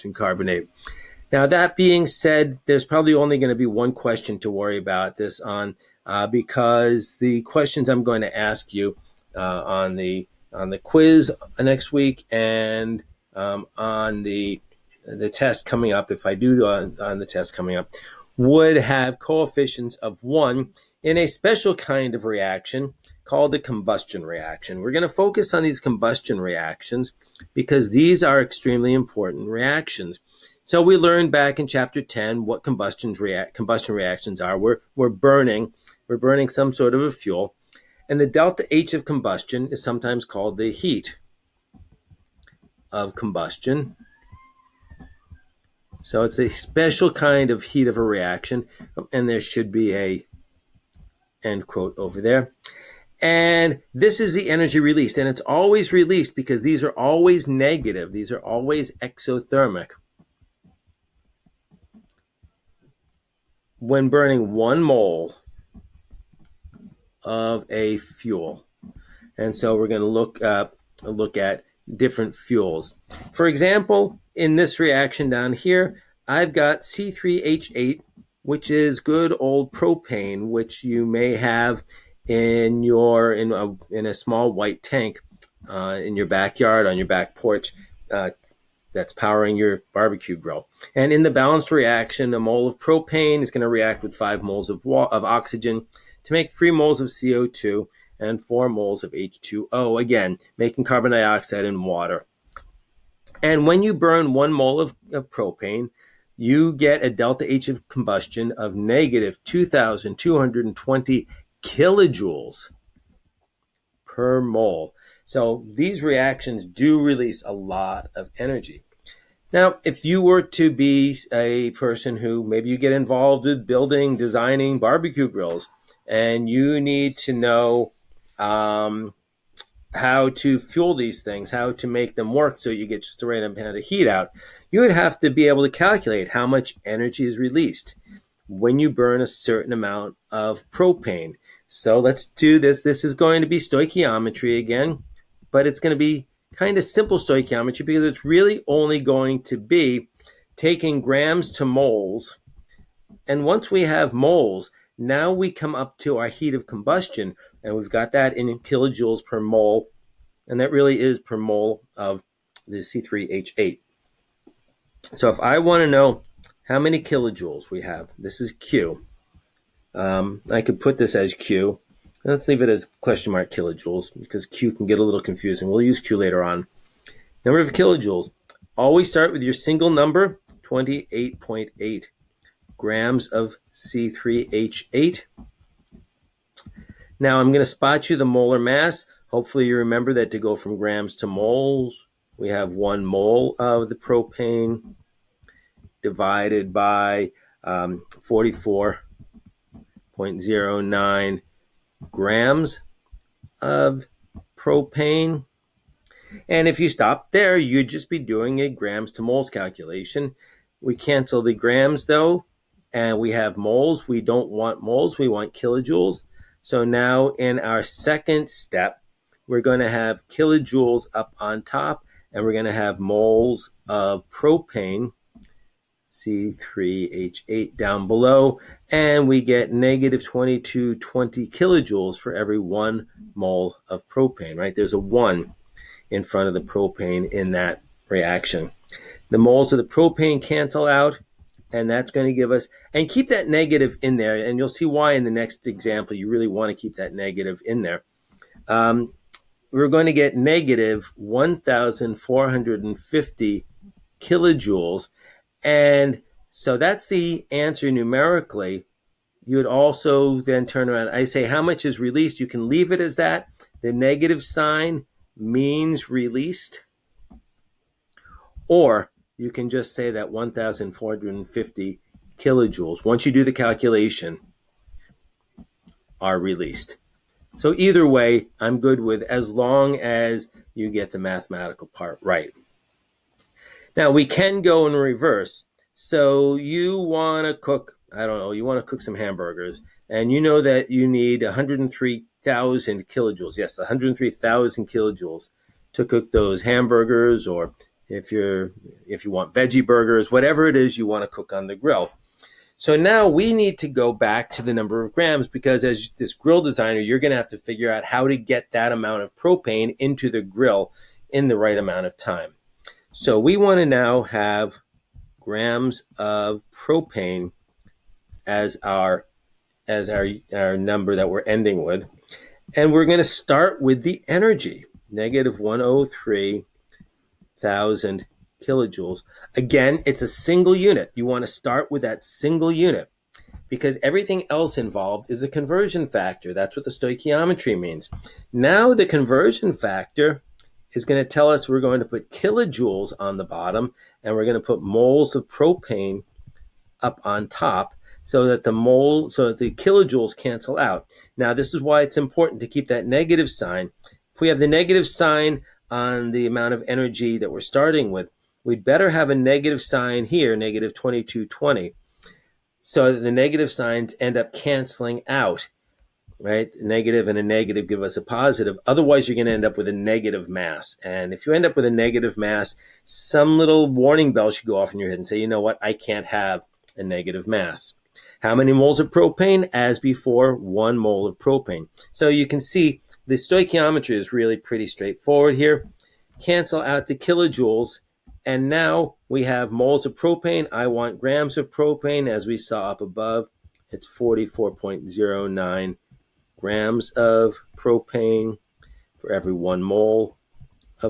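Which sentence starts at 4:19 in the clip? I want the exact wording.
You would also then turn around.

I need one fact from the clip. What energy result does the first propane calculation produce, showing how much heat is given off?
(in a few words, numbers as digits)
-1,450 kilojoules.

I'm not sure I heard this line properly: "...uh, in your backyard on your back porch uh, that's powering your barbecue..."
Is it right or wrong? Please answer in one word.
right.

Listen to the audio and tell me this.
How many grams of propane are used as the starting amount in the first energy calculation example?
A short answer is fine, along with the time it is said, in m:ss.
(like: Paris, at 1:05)
28.8 grams, at 3:00.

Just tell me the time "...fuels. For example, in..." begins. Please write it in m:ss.
1:12.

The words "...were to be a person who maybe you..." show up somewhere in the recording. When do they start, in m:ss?
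2:00.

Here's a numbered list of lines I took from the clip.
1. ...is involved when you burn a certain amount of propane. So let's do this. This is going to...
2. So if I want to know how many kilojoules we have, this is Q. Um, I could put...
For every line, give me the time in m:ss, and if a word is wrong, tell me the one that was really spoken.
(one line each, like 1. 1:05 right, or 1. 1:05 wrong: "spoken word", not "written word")
1. 2:17 wrong: "released", not "involved"
2. 2:45 right.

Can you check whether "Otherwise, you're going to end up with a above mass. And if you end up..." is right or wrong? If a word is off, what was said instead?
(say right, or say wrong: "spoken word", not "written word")
wrong: "negative", not "above".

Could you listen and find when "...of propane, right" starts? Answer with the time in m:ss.
3:53.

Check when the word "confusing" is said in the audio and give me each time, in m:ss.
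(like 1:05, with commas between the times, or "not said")
2:55.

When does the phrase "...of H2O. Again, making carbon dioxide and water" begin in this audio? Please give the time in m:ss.
1:39.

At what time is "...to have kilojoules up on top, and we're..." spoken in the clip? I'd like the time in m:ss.
3:39.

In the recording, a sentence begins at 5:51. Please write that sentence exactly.
Now, this is why it's important to keep that negative sign.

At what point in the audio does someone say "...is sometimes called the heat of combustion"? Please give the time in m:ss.
0:39.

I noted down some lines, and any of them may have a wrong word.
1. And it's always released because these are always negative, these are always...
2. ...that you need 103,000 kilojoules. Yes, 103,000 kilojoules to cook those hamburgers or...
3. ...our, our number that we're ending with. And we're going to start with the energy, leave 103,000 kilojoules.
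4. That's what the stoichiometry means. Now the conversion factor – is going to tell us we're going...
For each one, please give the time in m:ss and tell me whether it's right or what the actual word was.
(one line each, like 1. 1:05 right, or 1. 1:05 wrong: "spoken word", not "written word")
1. 0:55 right
2. 4:50 right
3. 5:20 wrong: "negative", not "leave"
4. 5:36 right.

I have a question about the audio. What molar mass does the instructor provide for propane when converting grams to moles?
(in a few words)
44.09 grams.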